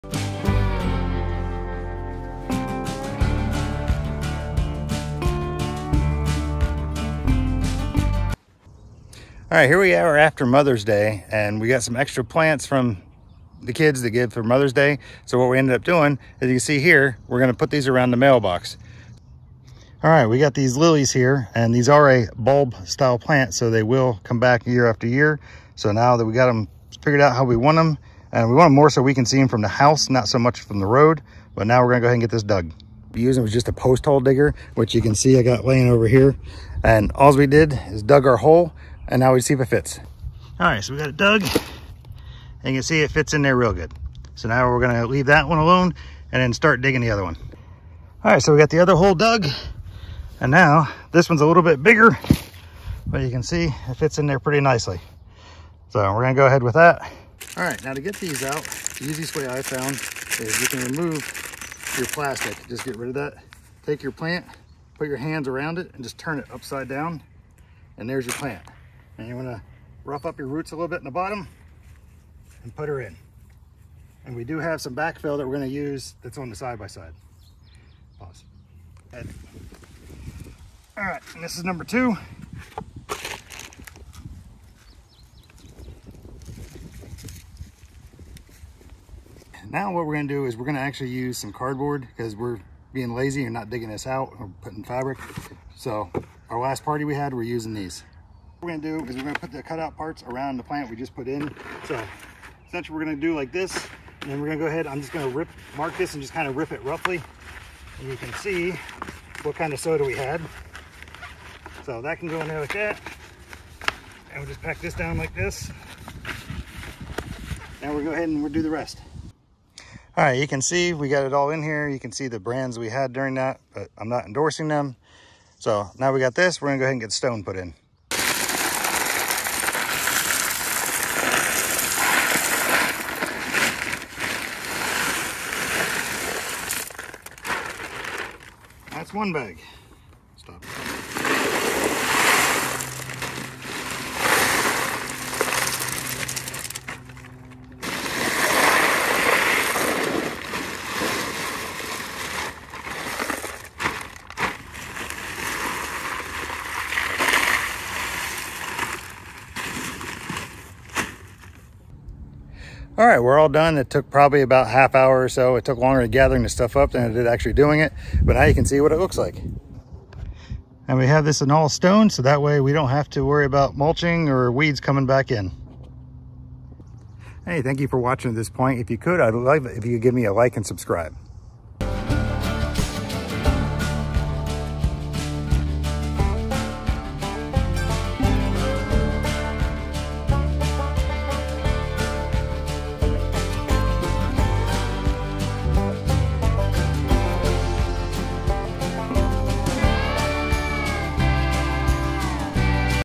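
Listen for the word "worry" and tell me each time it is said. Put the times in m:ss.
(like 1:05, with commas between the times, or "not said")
2:53.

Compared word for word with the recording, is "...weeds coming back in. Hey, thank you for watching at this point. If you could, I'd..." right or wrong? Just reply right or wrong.
right.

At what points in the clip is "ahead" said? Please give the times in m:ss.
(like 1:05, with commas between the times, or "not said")
0:32, 0:56, 1:44, 1:58, 2:06.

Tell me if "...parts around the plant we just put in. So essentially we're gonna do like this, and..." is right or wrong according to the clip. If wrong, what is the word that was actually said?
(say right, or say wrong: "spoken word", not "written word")
right.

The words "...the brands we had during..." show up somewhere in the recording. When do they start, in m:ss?
2:02.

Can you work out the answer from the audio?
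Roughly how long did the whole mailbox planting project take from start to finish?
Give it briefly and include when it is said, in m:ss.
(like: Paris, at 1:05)
Half hour, at 2:44.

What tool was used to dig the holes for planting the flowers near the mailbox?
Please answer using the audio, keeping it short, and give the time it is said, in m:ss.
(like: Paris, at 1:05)
Post hole digger, at 0:33.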